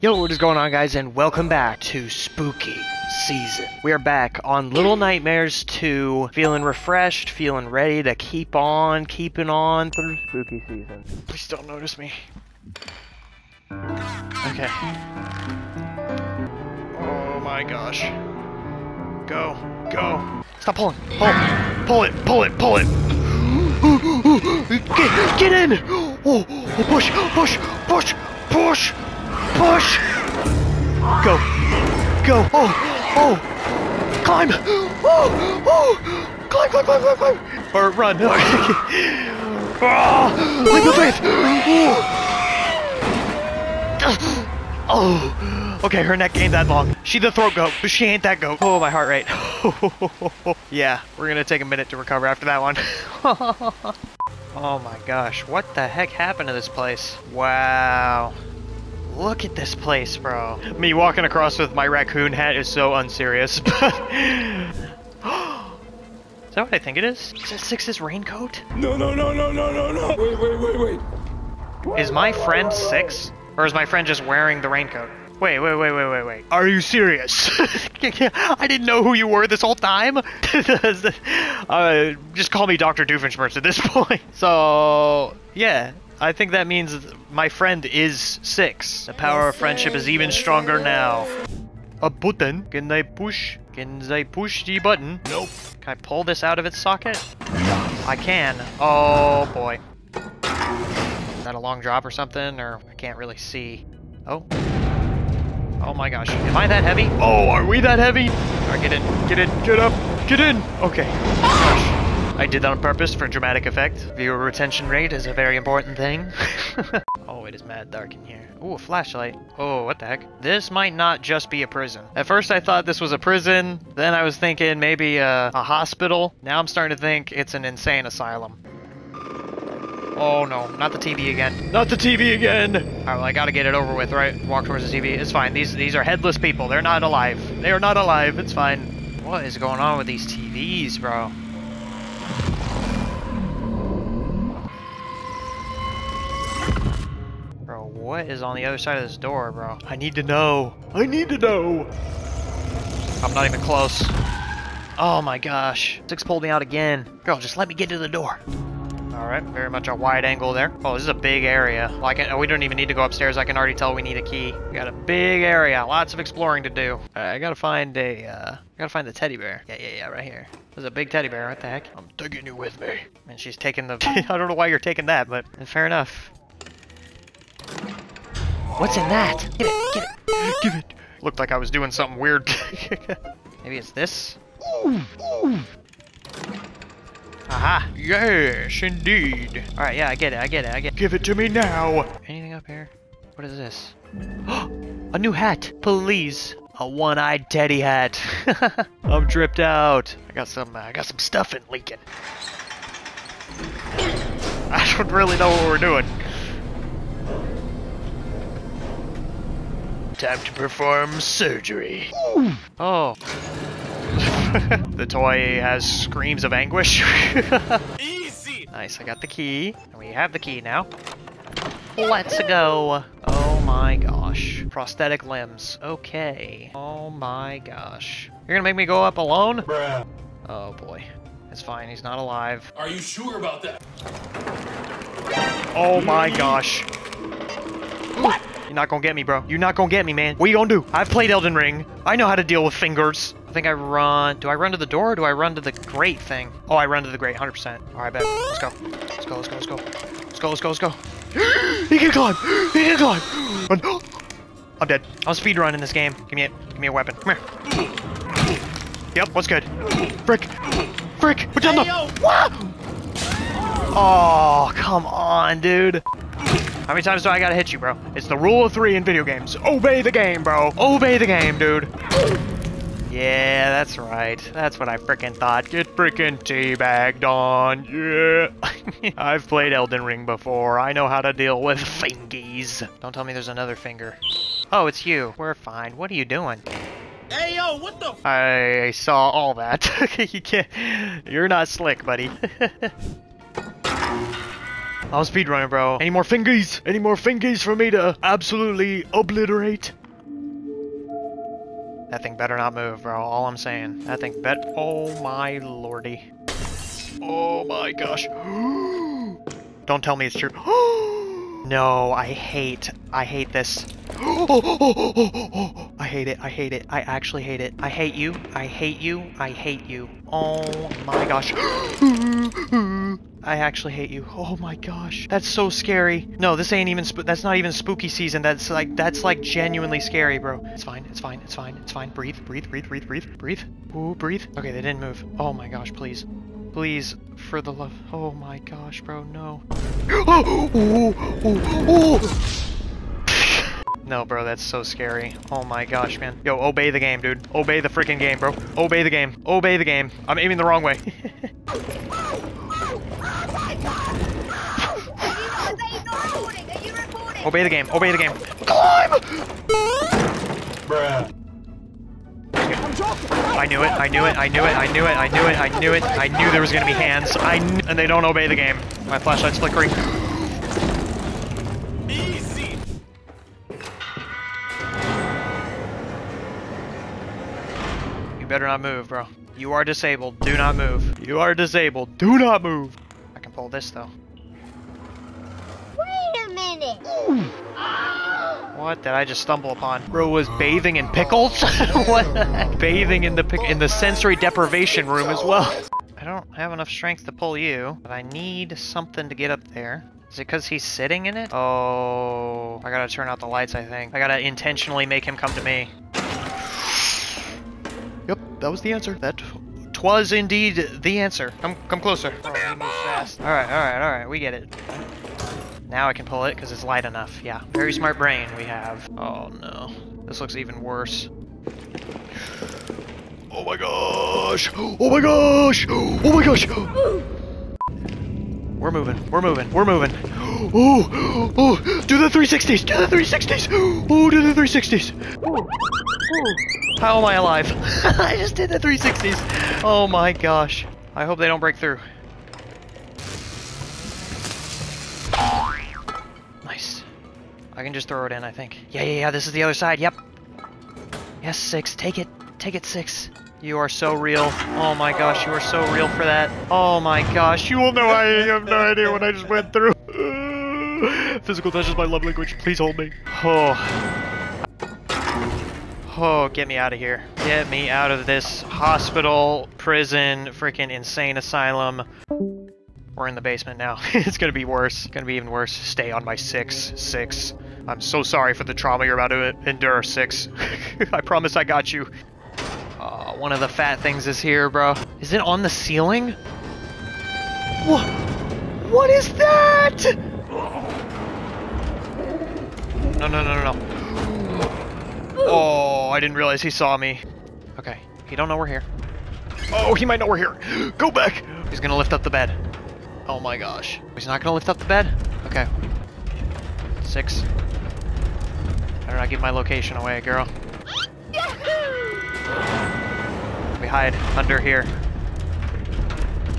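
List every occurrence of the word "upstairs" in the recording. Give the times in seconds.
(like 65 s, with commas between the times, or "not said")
163 s.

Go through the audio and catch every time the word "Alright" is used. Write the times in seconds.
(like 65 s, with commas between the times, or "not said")
108 s, 132 s.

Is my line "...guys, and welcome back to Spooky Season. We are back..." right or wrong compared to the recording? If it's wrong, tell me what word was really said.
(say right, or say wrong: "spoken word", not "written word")
right.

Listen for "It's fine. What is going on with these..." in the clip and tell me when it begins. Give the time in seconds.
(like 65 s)
138 s.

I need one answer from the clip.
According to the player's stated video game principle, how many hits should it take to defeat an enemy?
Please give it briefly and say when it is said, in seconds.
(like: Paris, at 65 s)
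3, at 268 s.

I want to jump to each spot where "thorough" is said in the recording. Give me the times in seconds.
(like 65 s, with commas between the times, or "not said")
not said.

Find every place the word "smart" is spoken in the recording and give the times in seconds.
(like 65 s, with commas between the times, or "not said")
417 s.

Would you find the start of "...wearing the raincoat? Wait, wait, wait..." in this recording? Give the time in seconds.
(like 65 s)
74 s.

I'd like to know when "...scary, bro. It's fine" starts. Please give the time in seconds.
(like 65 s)
329 s.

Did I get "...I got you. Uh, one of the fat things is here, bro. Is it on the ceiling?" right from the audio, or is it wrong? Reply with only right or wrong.
right.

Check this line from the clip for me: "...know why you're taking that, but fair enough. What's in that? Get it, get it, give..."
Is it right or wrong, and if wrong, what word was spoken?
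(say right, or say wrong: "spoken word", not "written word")
right.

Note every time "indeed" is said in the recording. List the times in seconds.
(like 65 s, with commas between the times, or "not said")
188 s, 410 s.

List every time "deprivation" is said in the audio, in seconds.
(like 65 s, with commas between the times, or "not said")
394 s.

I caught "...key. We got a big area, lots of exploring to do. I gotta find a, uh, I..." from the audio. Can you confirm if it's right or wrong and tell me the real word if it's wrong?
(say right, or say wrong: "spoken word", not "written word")
right.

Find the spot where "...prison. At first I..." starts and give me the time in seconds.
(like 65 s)
121 s.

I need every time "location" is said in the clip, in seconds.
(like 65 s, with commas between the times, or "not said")
509 s.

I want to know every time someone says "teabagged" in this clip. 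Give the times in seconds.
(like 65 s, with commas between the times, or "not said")
276 s.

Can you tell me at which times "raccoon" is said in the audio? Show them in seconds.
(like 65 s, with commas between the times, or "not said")
61 s.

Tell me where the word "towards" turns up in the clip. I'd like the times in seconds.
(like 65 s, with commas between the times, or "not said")
134 s.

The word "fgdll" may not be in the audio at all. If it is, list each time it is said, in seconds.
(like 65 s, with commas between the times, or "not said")
not said.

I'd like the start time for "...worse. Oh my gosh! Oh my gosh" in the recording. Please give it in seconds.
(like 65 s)
420 s.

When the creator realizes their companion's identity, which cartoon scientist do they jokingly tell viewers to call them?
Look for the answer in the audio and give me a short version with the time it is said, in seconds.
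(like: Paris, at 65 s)
Dr. Doofenshmirtz, at 82 s.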